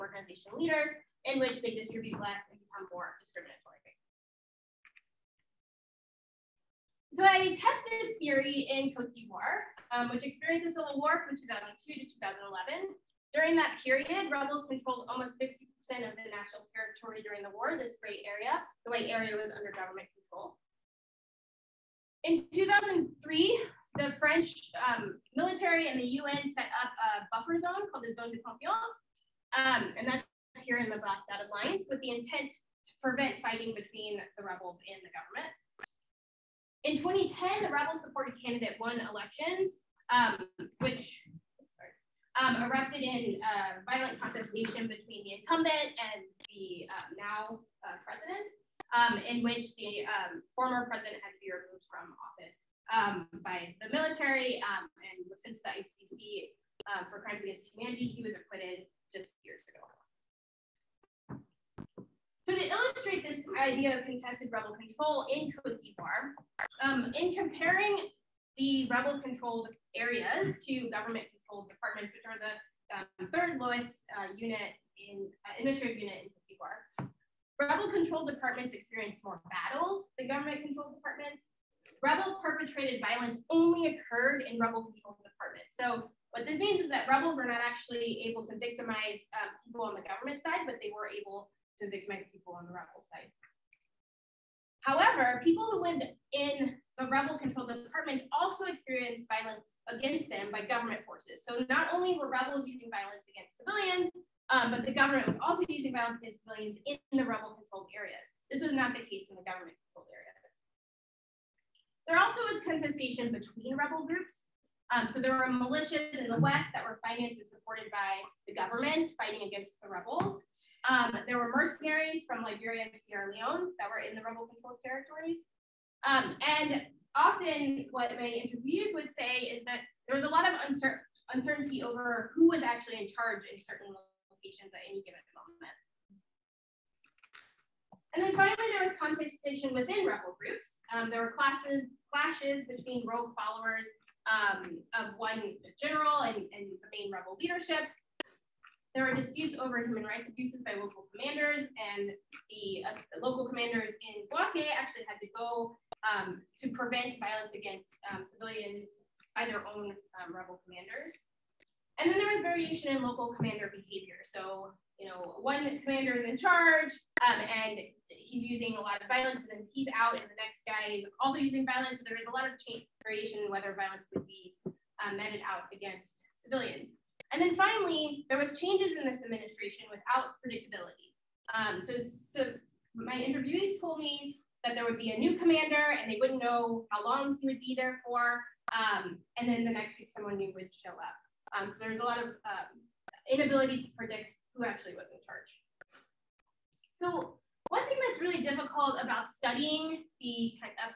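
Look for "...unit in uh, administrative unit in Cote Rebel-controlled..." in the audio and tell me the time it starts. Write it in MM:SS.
01:14.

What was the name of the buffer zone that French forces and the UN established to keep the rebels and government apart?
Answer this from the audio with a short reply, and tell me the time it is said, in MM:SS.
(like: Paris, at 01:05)
Zone de Confiance, at 00:28.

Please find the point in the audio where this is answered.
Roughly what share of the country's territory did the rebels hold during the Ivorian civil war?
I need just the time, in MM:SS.
00:15.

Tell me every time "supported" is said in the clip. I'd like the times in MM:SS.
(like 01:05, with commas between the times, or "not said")
00:38, 01:57.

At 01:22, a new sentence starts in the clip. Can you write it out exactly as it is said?
Rebel-perpetrated violence only occurred in rebel-controlled departments.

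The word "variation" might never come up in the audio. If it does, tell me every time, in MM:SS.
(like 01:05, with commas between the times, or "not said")
02:42, 02:53.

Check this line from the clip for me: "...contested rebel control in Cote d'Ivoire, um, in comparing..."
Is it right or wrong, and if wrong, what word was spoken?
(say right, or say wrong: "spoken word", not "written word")
right.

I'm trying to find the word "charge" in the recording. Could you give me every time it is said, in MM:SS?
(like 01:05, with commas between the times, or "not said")
02:13, 02:46, 03:15.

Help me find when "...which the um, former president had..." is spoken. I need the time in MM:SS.
00:49.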